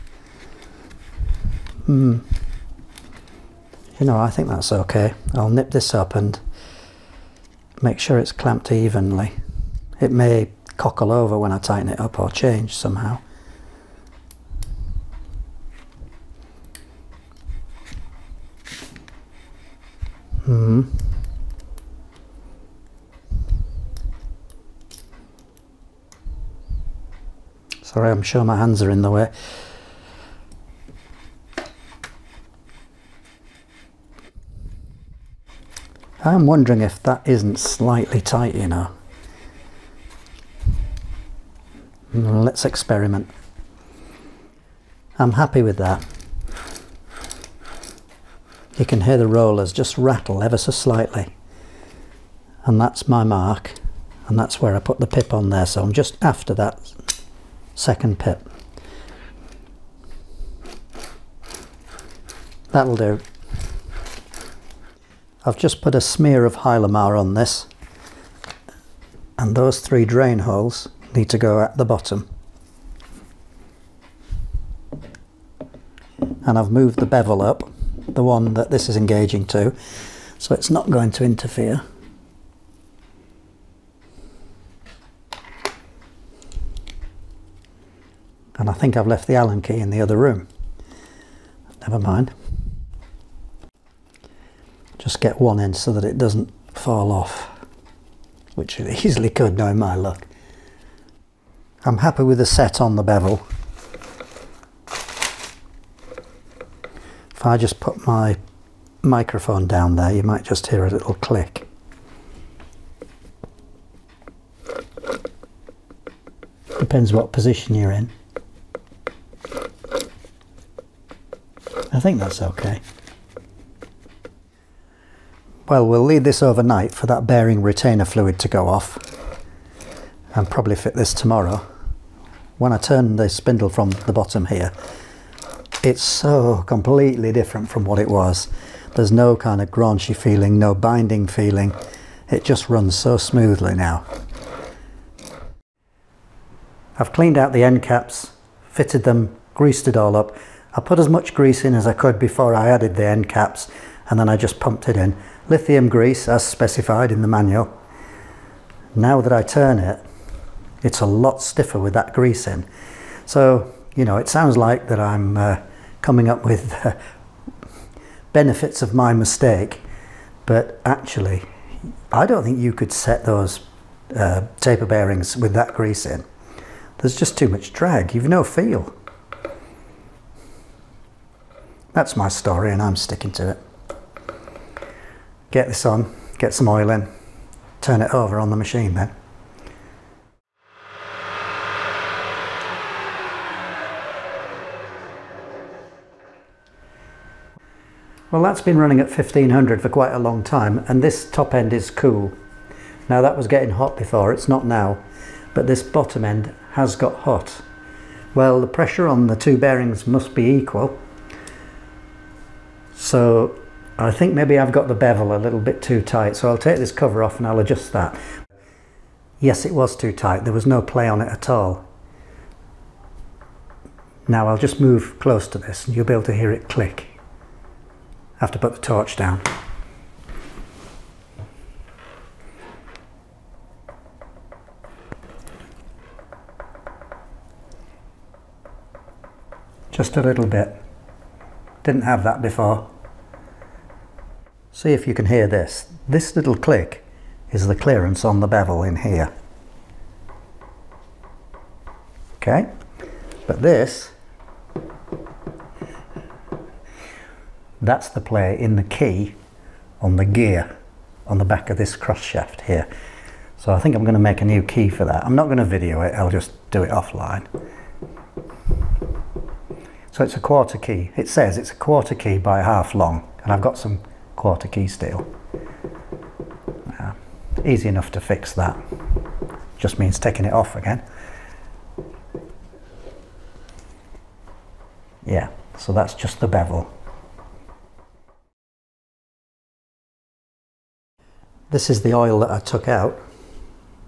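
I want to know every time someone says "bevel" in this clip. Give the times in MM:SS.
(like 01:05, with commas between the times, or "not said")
01:17, 01:43, 03:34, 04:08, 04:46.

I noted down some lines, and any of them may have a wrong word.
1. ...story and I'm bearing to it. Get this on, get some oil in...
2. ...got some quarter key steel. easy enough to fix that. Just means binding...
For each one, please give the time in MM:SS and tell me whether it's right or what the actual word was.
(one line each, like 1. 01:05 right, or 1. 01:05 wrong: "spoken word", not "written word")
1. 03:02 wrong: "sticking", not "bearing"
2. 04:33 wrong: "taking", not "binding".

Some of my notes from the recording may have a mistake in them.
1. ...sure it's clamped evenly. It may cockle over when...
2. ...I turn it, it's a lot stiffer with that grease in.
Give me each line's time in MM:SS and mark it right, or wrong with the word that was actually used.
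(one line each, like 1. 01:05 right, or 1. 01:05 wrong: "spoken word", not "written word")
1. 00:07 right
2. 02:39 right.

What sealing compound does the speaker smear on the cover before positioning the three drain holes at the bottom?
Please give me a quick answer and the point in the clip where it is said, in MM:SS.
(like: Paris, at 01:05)
Hylamar, at 01:06.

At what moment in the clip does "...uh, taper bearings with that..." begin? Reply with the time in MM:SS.
02:54.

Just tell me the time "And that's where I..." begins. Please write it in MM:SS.
00:54.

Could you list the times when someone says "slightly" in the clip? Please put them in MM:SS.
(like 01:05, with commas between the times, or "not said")
00:37, 00:50.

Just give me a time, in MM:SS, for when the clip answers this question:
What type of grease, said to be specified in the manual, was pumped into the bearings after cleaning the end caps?
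02:35.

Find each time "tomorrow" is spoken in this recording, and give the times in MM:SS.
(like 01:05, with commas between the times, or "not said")
02:11.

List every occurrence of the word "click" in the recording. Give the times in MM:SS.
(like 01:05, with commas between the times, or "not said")
01:51, 03:46, 04:06.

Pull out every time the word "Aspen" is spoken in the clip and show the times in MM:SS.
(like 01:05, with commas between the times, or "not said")
not said.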